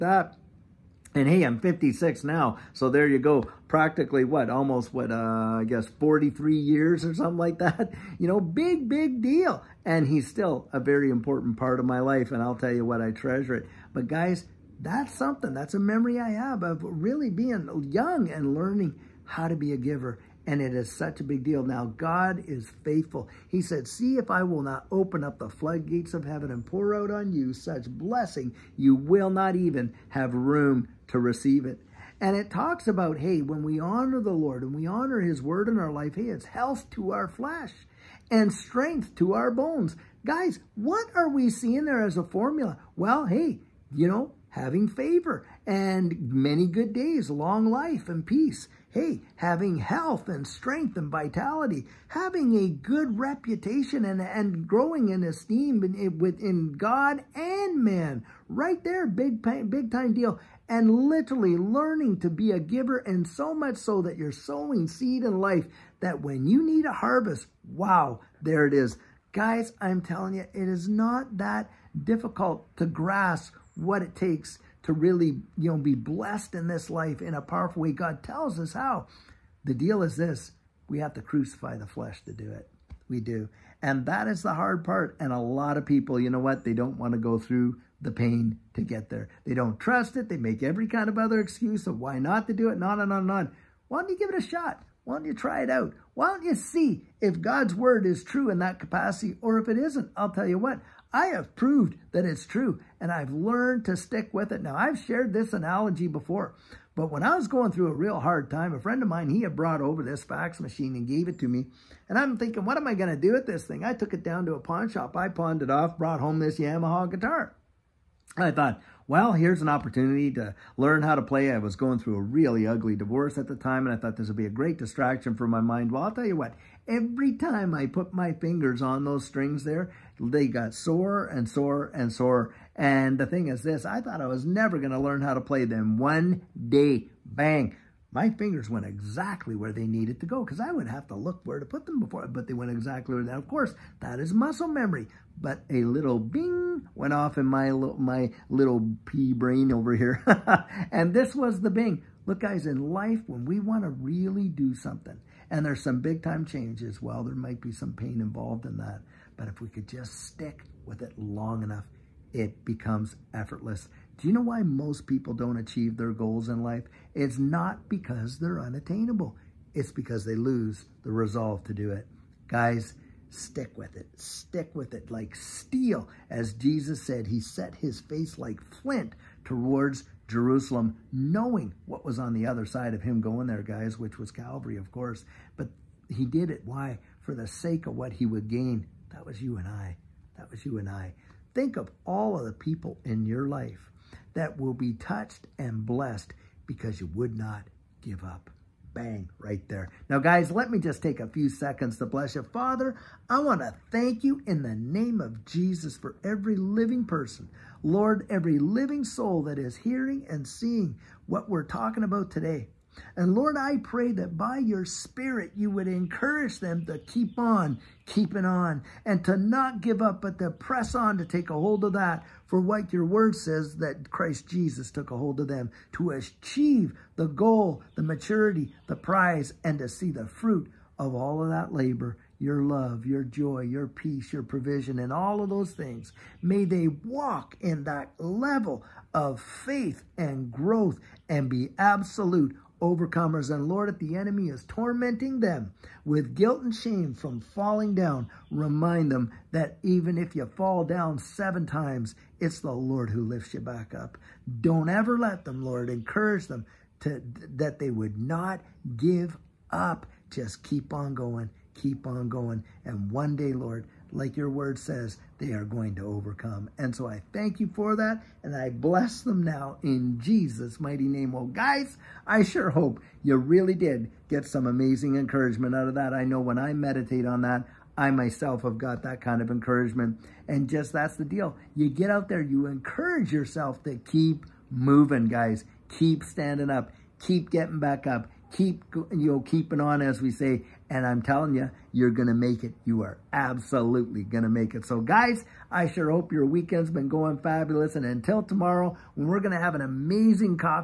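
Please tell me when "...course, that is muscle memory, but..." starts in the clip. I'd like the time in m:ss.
2:23.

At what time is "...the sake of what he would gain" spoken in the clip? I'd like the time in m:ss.
3:07.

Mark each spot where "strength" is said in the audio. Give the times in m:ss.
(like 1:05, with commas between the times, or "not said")
0:38, 0:50.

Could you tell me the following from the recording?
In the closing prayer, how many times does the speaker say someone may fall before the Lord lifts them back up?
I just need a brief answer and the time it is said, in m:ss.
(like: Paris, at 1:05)
7 times, at 4:11.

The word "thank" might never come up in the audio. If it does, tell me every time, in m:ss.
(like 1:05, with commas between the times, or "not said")
3:23, 4:27.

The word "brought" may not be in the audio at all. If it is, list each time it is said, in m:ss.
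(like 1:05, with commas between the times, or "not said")
1:49, 1:55.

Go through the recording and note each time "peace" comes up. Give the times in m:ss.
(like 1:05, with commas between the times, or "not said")
0:48, 3:53.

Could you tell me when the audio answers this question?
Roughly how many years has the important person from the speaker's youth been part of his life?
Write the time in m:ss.
0:05.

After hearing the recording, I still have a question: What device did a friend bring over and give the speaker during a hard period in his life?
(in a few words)
fax machine.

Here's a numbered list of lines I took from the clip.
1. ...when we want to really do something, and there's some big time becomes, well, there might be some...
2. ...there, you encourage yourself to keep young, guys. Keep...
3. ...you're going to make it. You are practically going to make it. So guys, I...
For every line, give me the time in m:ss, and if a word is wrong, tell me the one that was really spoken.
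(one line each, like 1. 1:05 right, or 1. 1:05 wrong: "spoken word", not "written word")
1. 2:33 wrong: "changes", not "becomes"
2. 4:42 wrong: "moving", not "young"
3. 4:51 wrong: "absolutely", not "practically".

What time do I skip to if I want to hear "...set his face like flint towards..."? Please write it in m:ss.
2:57.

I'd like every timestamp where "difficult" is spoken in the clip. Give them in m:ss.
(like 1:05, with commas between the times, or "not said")
1:12.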